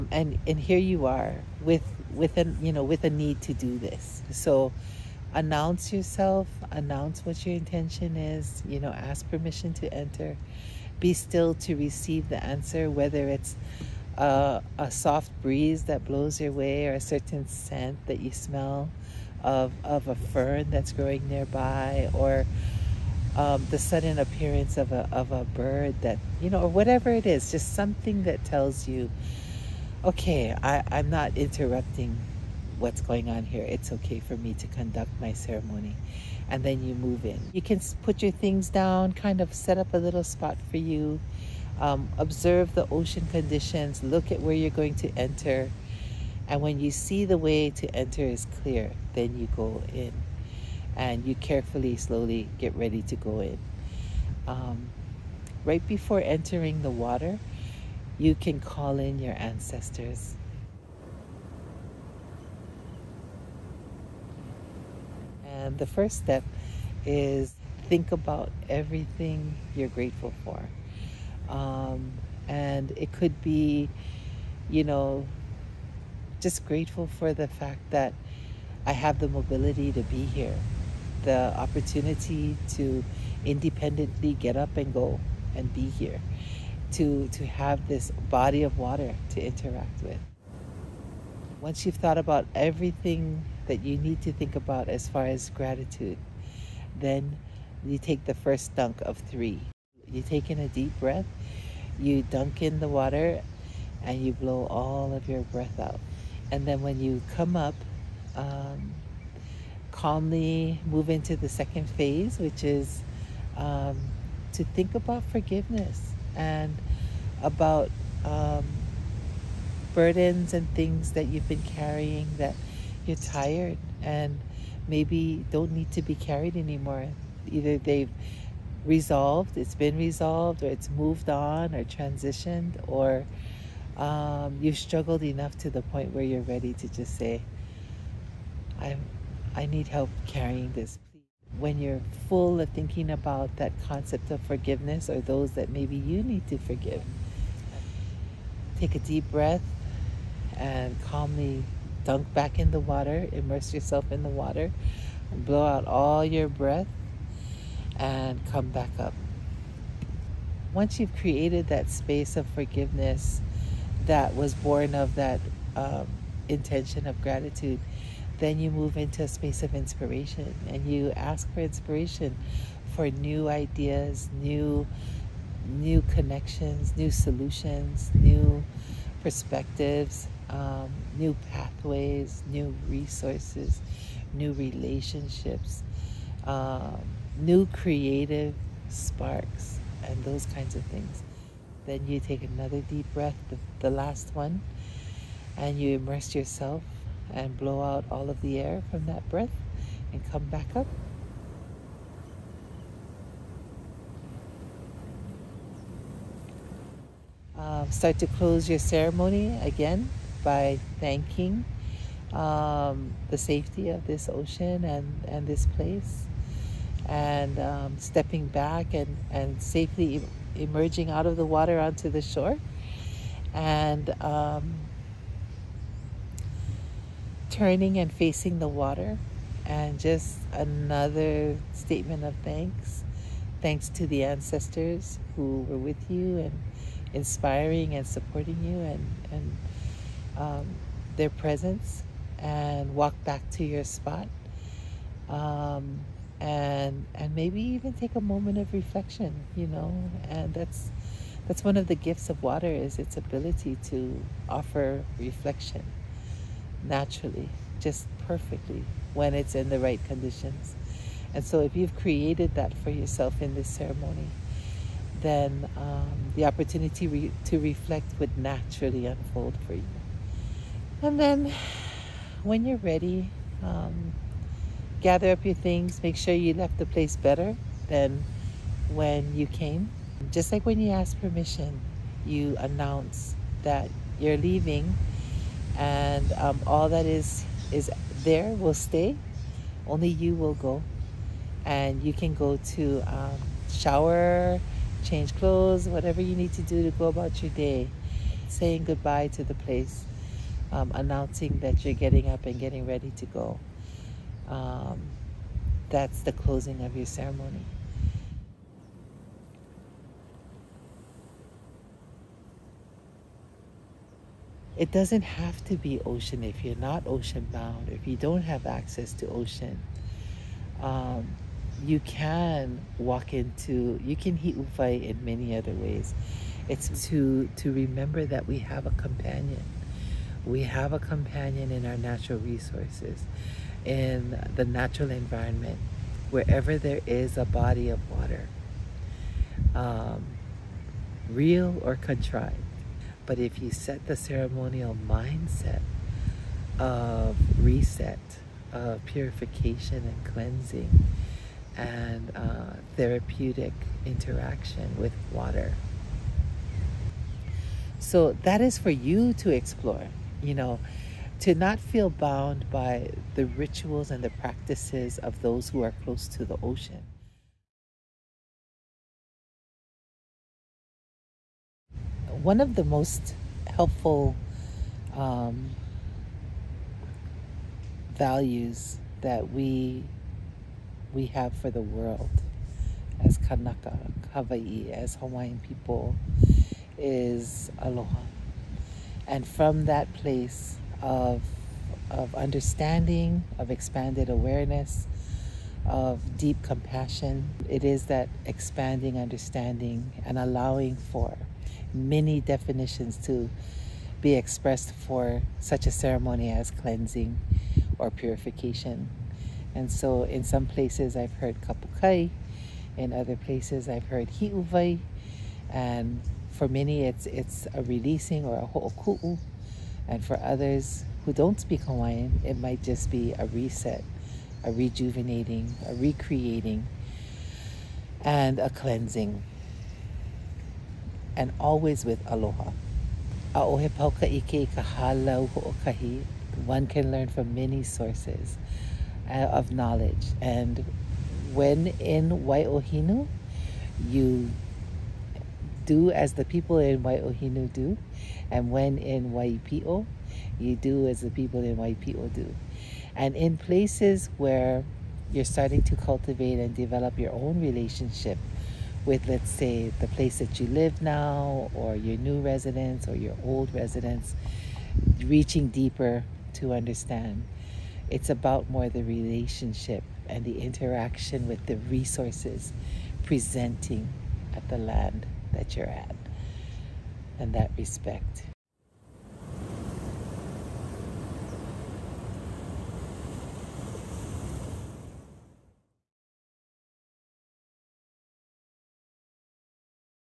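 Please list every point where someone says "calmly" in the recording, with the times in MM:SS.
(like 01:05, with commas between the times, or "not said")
01:49, 02:31.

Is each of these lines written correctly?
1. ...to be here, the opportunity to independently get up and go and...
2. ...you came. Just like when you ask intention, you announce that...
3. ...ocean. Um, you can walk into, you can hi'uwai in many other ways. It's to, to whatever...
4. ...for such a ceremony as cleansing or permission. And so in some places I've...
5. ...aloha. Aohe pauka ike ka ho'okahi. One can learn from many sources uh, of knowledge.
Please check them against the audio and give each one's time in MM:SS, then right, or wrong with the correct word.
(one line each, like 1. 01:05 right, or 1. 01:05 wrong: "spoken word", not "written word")
1. 01:19 right
2. 04:39 wrong: "permission", not "intention"
3. 05:19 wrong: "remember", not "whatever"
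4. 06:44 wrong: "purification", not "permission"
5. 07:12 right.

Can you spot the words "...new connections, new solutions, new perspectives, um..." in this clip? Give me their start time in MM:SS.
02:55.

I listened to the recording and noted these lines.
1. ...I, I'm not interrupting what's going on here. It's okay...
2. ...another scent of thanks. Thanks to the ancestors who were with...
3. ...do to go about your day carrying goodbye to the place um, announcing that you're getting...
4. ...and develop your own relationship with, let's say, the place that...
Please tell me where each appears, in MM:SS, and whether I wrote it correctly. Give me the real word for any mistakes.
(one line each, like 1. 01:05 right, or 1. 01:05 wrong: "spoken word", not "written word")
1. 00:30 right
2. 03:50 wrong: "statement", not "scent"
3. 04:56 wrong: "saying", not "carrying"
4. 07:36 right.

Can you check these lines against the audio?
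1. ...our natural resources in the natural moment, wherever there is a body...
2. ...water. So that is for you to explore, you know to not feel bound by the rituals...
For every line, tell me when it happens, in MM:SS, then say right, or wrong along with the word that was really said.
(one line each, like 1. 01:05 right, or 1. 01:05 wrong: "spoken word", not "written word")
1. 05:31 wrong: "environment", not "moment"
2. 05:55 right.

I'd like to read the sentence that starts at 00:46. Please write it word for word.
And when you see the way to enter is clear, then you go in.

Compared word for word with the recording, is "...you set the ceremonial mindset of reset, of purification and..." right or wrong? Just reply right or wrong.
right.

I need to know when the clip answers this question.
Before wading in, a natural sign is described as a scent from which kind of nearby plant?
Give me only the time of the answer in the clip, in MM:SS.
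00:20.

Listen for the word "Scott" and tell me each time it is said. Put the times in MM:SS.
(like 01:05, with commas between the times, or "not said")
not said.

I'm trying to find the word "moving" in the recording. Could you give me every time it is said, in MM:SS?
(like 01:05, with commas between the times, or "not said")
not said.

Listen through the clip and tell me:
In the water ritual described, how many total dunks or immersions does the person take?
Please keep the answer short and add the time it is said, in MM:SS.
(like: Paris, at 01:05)
3, at 01:39.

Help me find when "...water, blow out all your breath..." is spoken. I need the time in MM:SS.
02:34.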